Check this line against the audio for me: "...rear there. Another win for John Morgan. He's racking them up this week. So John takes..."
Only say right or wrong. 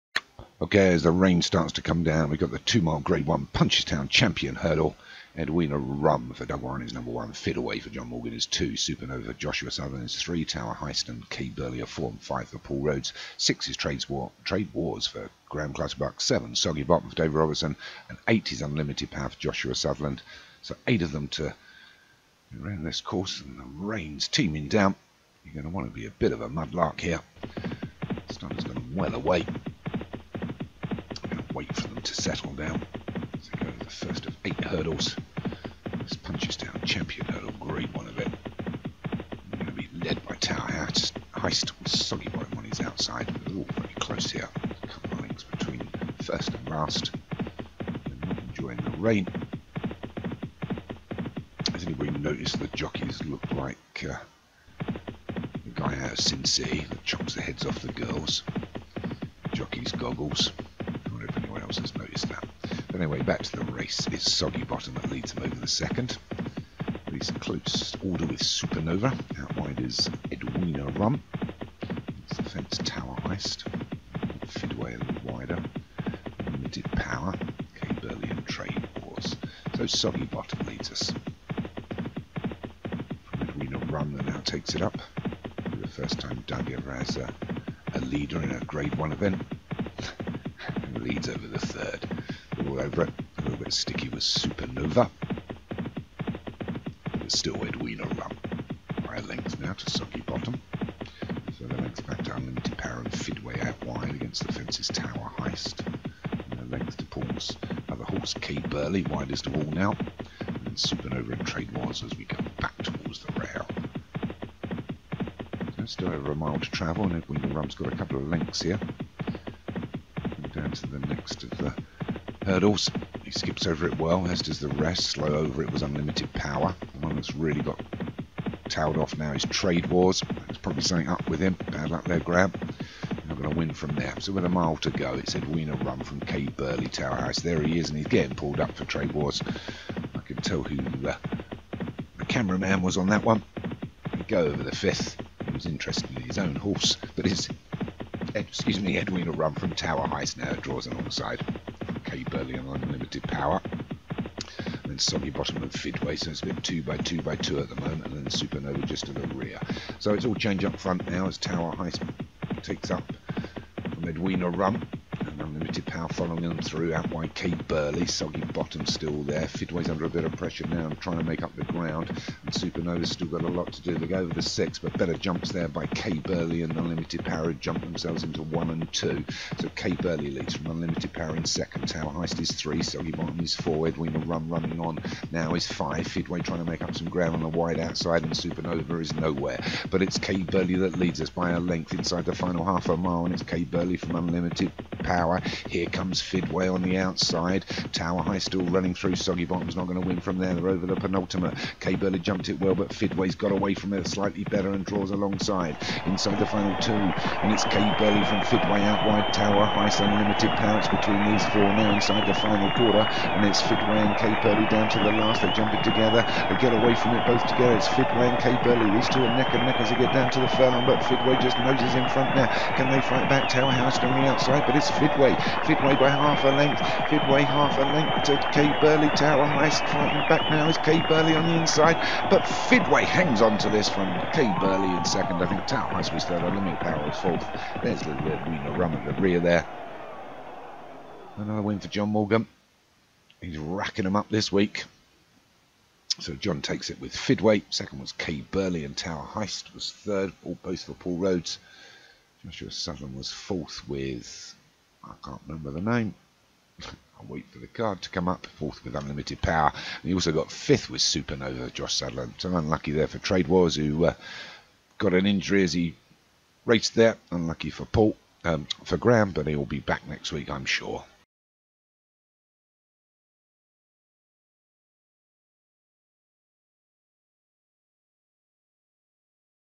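right.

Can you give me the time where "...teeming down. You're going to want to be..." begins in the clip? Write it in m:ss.
0:24.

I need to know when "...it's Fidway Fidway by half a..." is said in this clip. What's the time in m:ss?
3:44.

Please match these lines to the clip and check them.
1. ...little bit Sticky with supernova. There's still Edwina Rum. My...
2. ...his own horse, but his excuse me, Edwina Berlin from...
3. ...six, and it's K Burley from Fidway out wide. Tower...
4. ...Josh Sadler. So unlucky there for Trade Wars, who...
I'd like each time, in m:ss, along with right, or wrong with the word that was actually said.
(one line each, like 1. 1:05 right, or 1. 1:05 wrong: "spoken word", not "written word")
1. 1:33 right
2. 2:26 wrong: "Rum", not "Berlin"
3. 3:26 wrong: "two", not "six"
4. 4:21 right.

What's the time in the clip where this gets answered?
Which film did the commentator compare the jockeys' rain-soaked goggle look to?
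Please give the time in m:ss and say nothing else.
0:56.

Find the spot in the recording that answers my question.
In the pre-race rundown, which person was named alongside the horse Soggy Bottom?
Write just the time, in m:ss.
0:17.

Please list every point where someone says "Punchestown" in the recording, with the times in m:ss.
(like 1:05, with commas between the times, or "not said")
0:03, 0:36.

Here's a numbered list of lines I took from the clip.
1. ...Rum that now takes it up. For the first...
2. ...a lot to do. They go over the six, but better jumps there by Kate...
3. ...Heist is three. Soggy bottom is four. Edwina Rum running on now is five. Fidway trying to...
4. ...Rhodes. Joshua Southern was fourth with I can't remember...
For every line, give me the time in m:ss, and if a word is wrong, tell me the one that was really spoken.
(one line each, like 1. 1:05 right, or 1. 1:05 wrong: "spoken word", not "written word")
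1. 1:23 right
2. 2:53 right
3. 3:02 right
4. 4:11 right.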